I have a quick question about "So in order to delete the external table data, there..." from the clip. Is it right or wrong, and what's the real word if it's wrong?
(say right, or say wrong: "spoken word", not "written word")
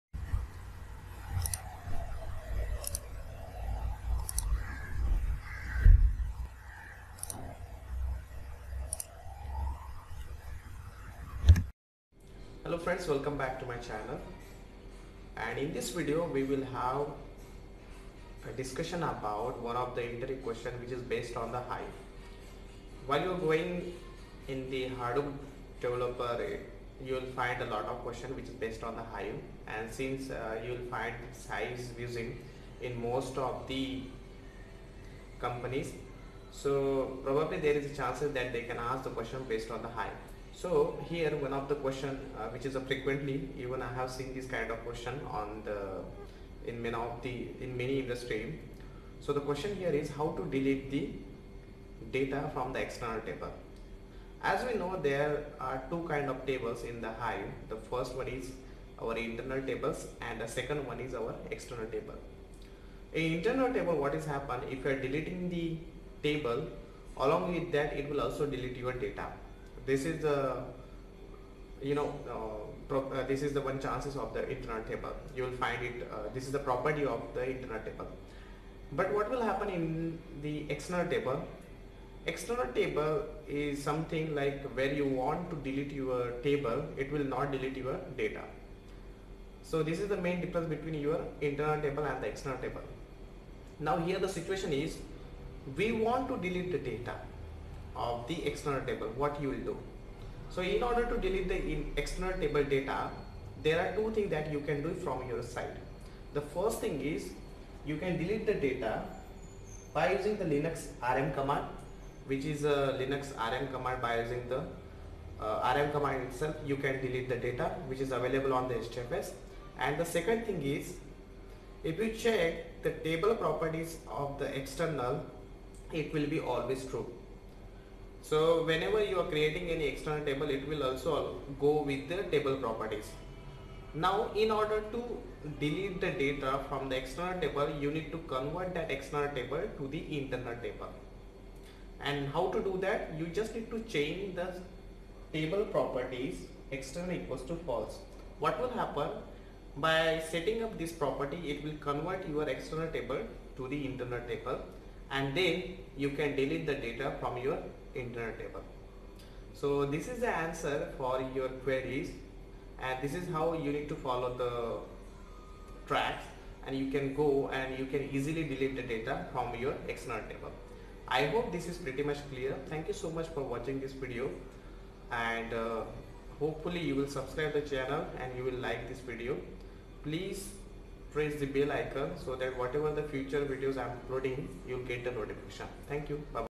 right.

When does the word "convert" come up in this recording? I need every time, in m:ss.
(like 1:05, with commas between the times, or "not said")
2:18, 2:31.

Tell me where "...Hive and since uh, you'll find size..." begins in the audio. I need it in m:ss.
0:29.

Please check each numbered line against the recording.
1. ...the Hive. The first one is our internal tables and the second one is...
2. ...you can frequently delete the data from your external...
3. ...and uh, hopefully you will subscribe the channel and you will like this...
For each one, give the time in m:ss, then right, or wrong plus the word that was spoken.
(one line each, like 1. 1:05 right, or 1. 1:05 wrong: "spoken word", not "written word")
1. 0:57 right
2. 2:47 wrong: "easily", not "frequently"
3. 2:55 right.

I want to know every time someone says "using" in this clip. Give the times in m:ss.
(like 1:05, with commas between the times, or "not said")
0:31, 1:50, 1:54.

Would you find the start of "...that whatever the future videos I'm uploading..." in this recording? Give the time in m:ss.
3:02.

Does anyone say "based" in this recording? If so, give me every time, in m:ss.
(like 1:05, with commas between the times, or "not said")
0:21, 0:28, 0:39.